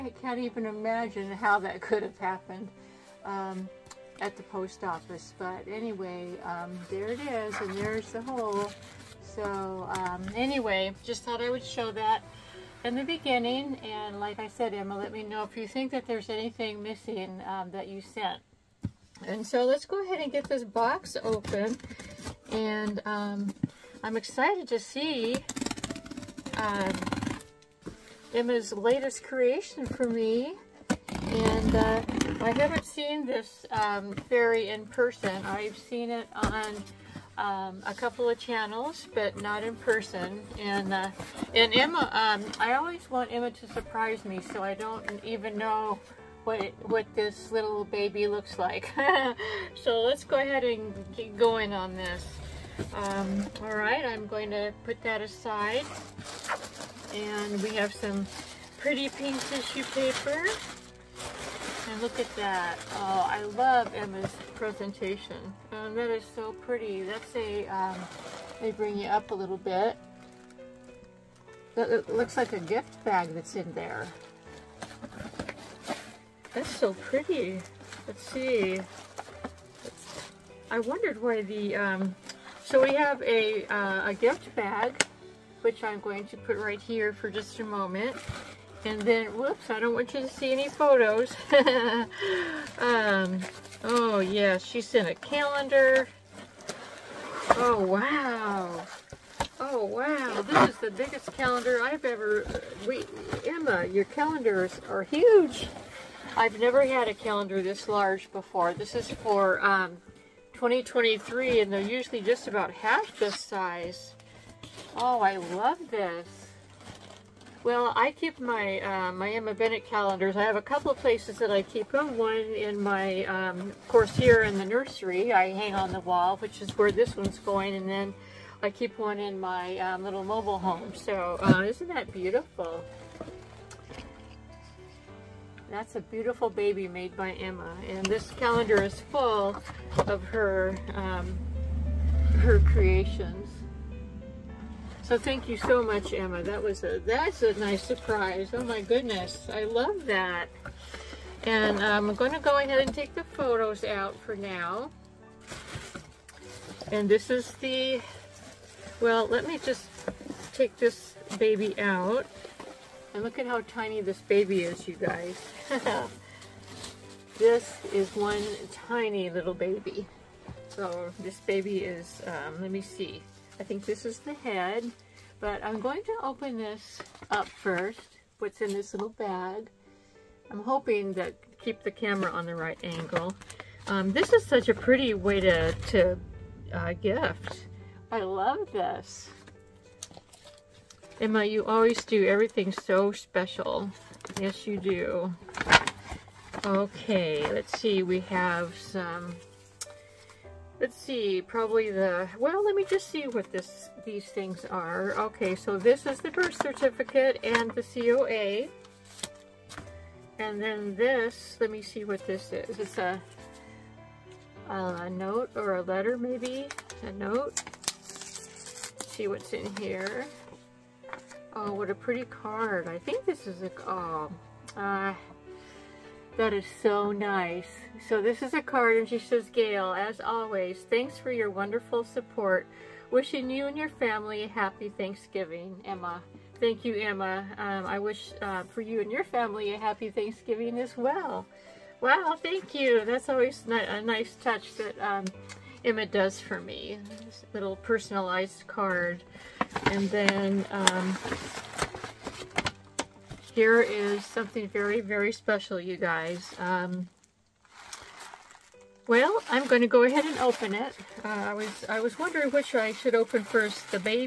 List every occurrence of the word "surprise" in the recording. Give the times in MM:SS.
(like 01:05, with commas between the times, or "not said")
00:43, 02:27.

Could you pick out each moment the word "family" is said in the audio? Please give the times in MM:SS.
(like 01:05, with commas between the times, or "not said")
03:53, 03:59.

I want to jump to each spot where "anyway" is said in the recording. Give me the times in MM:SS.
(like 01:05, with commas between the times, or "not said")
00:05, 00:10.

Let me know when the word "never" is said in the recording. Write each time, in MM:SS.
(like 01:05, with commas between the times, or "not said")
01:46.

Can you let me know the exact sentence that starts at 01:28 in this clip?
And then, whoops, I don't want you to see any photos.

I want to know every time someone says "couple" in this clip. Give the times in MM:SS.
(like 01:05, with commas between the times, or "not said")
00:37, 02:00.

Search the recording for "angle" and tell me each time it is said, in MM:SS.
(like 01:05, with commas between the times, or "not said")
03:02.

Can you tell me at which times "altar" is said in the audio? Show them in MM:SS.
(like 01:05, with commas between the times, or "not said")
not said.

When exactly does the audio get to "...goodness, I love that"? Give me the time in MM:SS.
02:28.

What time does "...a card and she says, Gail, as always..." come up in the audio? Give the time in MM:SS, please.
03:48.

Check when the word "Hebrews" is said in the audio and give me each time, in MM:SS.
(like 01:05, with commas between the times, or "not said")
not said.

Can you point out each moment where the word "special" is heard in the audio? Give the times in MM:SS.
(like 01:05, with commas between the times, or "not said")
03:13, 04:15.